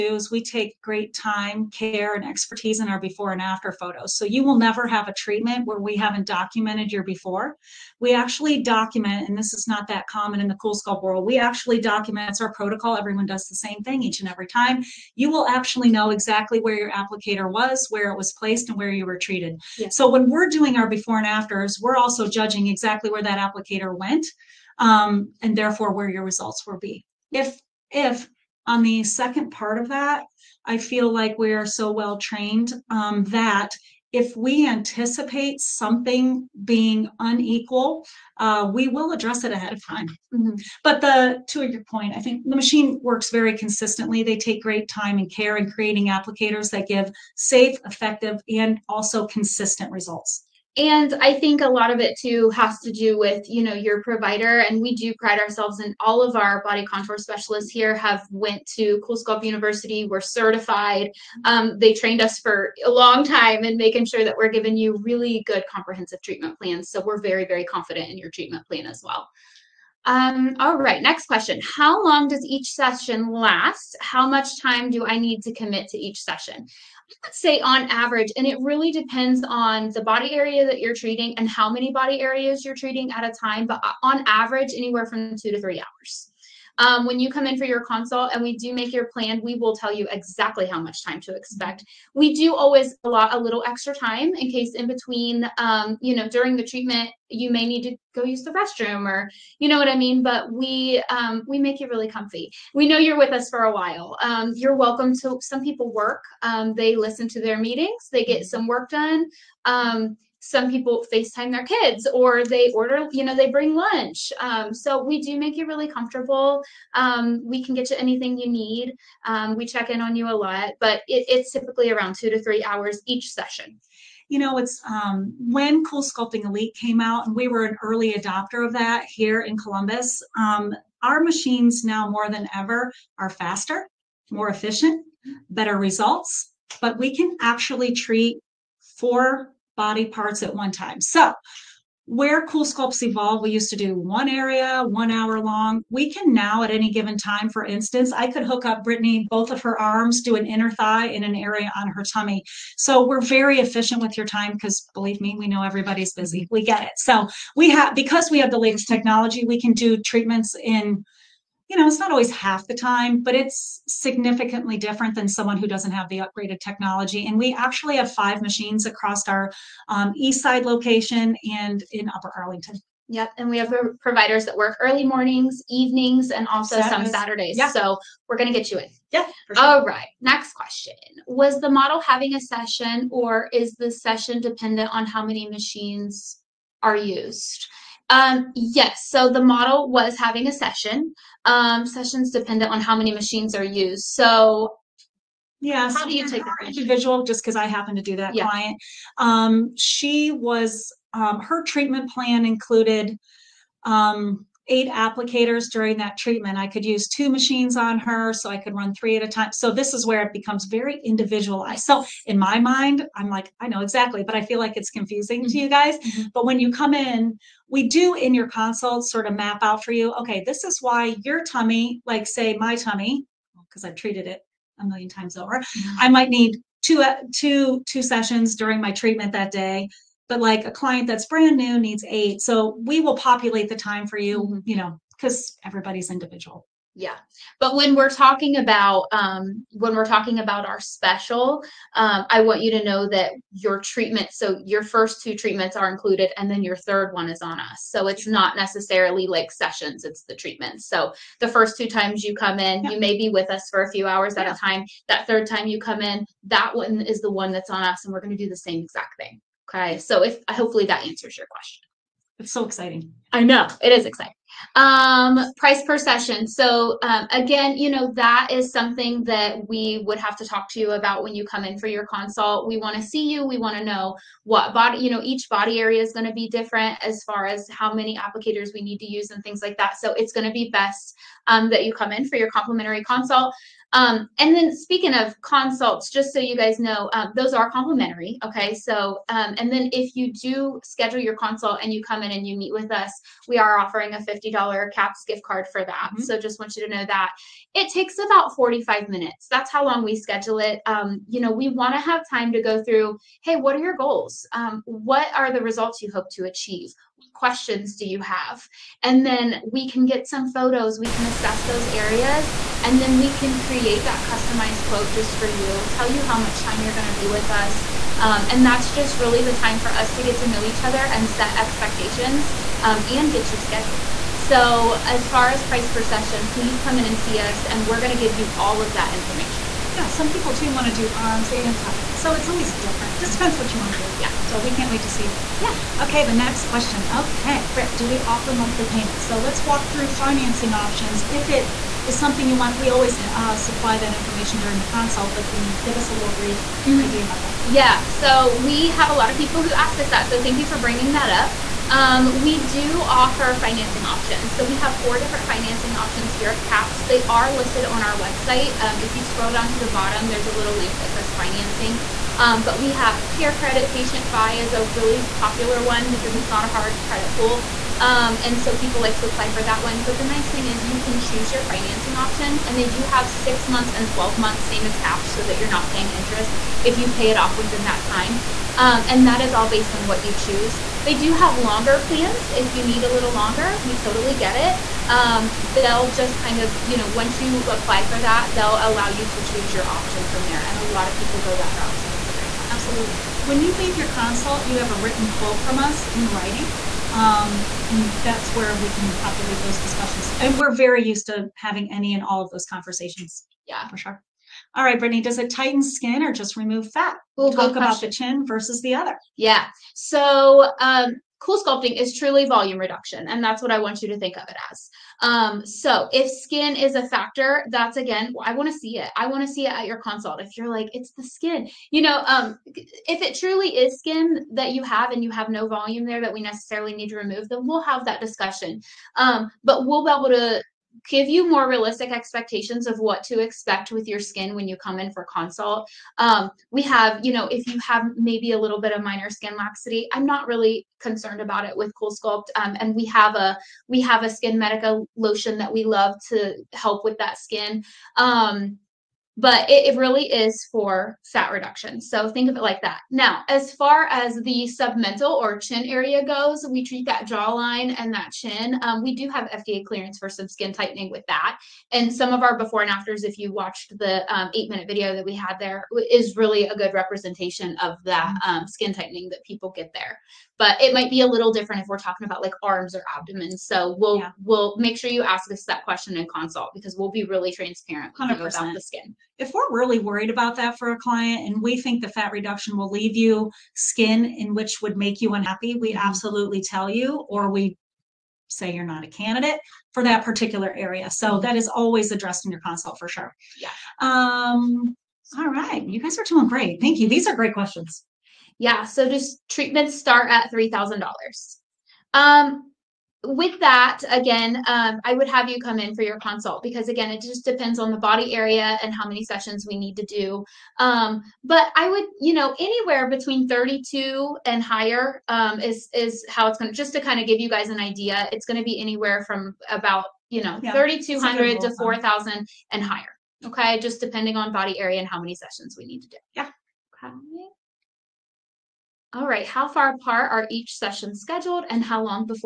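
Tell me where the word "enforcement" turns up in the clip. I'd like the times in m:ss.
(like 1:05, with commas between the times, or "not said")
not said.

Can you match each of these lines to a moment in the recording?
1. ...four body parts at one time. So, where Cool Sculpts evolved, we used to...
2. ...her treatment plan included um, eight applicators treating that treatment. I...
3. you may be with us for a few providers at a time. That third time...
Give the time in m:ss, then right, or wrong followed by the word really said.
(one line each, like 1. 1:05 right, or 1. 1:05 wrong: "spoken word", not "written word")
1. 2:18 right
2. 3:21 wrong: "during", not "treating"
3. 4:12 wrong: "hours", not "providers".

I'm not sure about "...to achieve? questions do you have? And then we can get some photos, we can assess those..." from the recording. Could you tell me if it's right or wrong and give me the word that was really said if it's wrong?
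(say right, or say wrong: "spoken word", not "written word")
right.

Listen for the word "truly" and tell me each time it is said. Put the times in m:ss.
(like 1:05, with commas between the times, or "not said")
6:52, 7:03.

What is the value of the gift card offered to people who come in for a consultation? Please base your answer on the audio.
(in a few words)
$50.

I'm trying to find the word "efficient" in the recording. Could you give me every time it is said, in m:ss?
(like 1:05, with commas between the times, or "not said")
2:14, 2:33.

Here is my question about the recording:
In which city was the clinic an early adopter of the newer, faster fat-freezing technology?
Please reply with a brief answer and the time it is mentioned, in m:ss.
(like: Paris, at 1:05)
Columbus, at 2:09.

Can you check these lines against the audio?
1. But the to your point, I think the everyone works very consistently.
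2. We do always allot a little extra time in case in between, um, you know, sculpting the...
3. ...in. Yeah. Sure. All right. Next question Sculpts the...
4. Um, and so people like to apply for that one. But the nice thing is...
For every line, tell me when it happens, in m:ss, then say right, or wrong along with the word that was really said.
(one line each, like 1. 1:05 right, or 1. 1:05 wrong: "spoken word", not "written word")
1. 0:40 wrong: "machine", not "everyone"
2. 1:32 wrong: "during", not "sculpting"
3. 2:58 wrong: "Was", not "Sculpts"
4. 6:08 right.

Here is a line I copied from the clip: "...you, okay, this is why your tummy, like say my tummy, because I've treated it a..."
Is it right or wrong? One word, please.
right.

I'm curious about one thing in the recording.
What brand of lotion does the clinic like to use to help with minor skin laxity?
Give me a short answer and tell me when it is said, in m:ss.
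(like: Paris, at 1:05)
SkinMedica, at 7:24.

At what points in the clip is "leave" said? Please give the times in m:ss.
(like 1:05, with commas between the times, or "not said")
6:33, 8:02.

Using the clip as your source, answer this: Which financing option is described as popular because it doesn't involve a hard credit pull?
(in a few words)
PatientFi.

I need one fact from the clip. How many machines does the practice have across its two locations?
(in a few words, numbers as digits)
5.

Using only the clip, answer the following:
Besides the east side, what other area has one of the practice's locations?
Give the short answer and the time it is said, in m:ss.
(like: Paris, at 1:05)
Upper Arlington, at 2:52.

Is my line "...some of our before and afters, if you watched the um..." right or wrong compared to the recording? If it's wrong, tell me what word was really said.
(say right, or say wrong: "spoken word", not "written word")
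right.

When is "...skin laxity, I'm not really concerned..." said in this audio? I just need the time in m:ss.
7:19.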